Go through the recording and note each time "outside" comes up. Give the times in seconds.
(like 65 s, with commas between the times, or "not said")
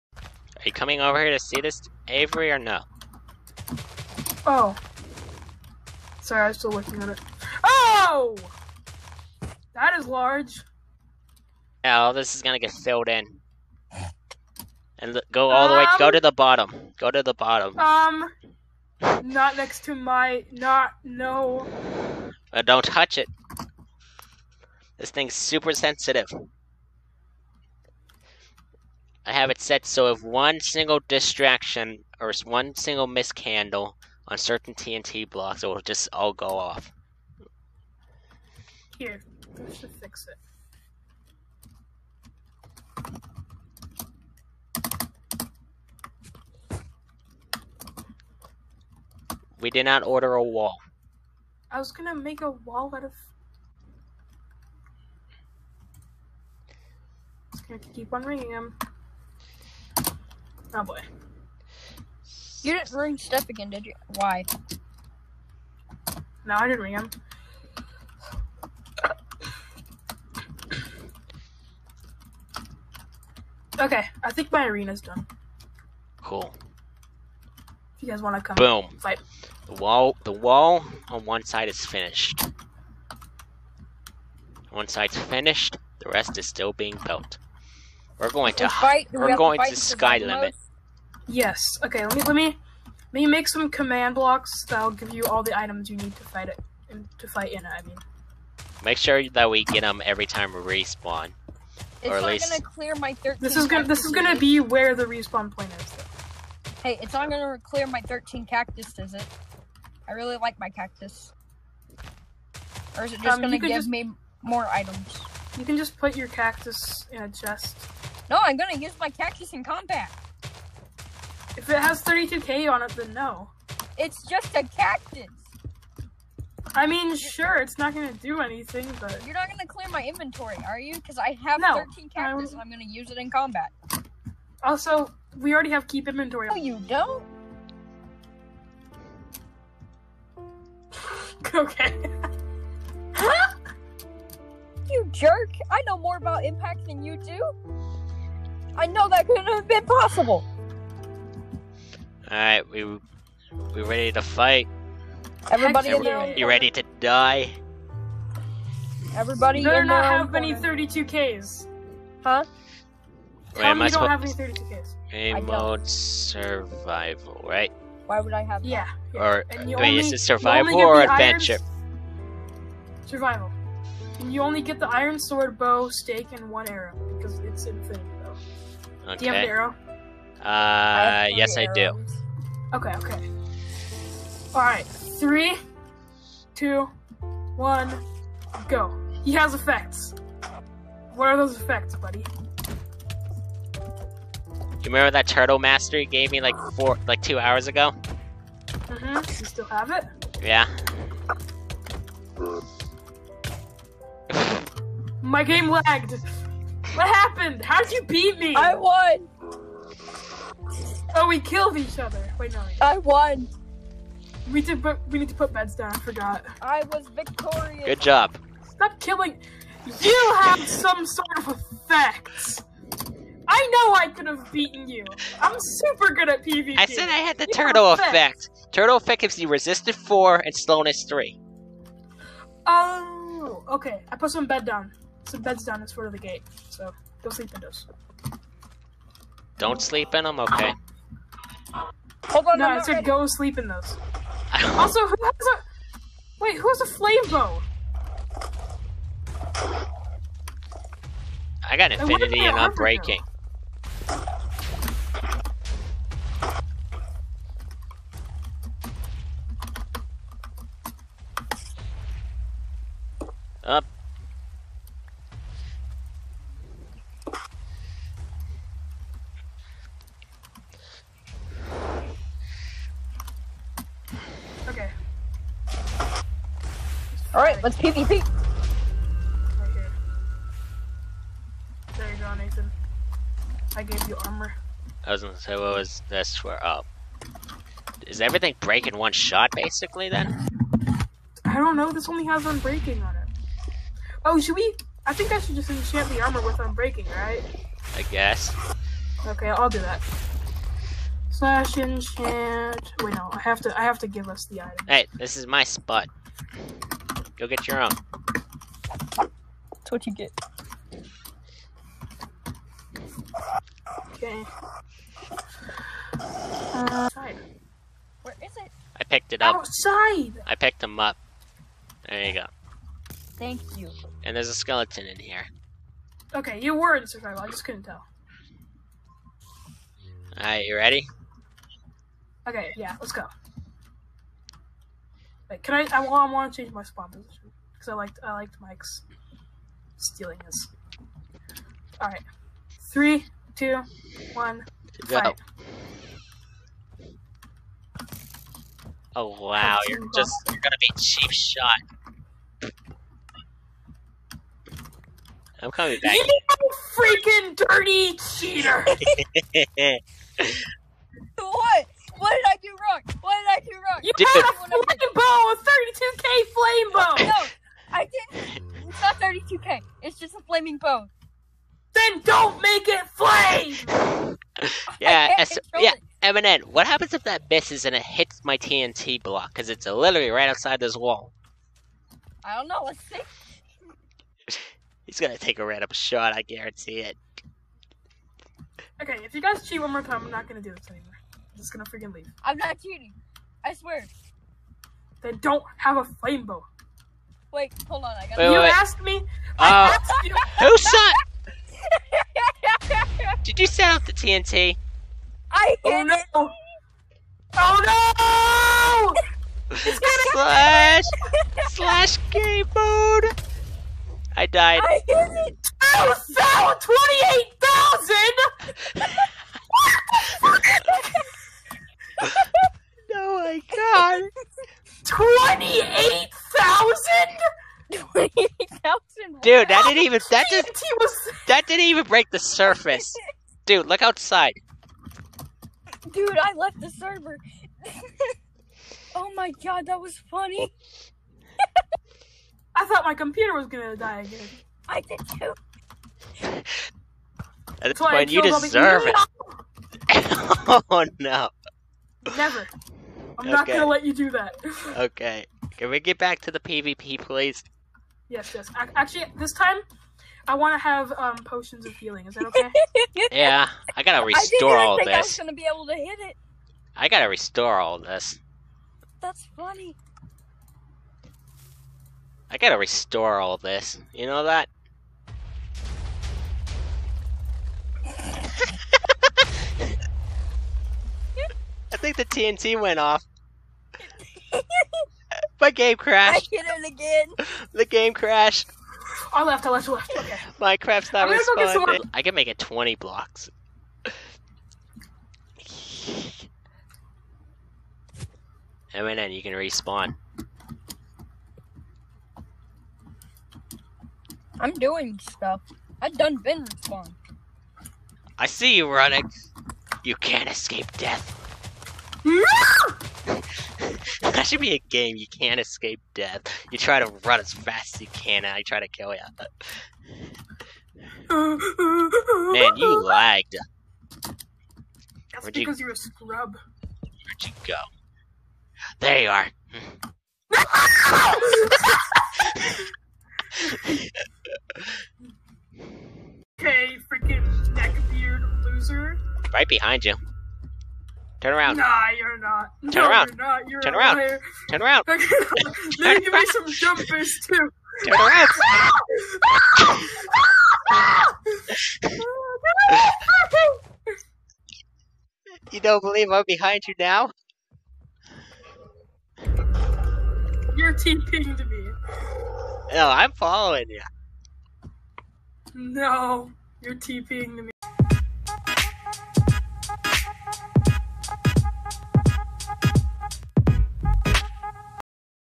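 319 s, 380 s, 434 s.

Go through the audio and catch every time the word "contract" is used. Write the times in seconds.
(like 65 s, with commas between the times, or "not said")
not said.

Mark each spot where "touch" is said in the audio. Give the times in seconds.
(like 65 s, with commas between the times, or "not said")
22 s.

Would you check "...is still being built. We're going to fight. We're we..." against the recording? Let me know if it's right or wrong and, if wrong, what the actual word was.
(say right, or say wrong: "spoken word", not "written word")
right.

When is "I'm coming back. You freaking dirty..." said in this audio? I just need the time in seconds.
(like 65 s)
355 s.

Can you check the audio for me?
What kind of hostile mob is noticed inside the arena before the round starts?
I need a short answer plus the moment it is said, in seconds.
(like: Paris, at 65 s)
Skeleton, at 324 s.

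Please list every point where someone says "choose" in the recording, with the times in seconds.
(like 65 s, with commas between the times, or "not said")
not said.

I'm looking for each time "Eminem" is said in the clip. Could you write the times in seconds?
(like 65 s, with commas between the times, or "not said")
376 s.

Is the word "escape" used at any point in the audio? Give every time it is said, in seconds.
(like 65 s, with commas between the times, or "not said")
510 s, 515 s.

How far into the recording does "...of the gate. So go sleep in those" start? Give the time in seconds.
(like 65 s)
236 s.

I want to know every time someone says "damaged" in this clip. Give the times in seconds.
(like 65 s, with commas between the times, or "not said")
not said.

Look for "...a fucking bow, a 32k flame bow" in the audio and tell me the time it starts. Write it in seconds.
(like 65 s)
364 s.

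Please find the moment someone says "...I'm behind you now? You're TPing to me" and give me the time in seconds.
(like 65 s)
556 s.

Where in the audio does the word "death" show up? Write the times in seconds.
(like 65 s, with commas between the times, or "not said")
510 s, 516 s.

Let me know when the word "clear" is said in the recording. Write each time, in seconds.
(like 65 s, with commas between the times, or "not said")
102 s, 107 s, 129 s.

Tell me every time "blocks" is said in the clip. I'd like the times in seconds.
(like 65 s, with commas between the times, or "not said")
35 s, 94 s, 379 s, 492 s.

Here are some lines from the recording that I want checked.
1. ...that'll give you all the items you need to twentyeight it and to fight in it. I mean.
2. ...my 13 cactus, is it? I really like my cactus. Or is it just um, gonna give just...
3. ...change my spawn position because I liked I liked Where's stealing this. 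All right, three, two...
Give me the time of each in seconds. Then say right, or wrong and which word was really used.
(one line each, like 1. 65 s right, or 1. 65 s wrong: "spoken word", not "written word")
1. 94 s wrong: "fight", not "twentyeight"
2. 107 s right
3. 336 s wrong: "Mike", not "Where".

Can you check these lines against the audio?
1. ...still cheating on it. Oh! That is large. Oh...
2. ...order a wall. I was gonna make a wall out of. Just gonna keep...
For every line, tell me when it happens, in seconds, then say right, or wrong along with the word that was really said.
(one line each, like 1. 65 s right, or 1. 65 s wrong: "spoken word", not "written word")
1. 6 s wrong: "working", not "cheating"
2. 50 s right.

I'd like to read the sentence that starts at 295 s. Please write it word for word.
I think I should just enchant the armor with unbreaking, right?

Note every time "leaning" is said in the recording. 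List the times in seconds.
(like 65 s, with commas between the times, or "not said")
not said.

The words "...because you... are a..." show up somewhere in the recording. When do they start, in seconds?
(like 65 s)
525 s.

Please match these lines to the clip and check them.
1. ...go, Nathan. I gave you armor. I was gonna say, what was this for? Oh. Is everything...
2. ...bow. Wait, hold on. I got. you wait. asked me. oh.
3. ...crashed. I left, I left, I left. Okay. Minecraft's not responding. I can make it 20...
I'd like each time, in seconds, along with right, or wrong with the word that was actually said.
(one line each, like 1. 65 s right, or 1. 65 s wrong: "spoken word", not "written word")
1. 282 s right
2. 396 s right
3. 488 s right.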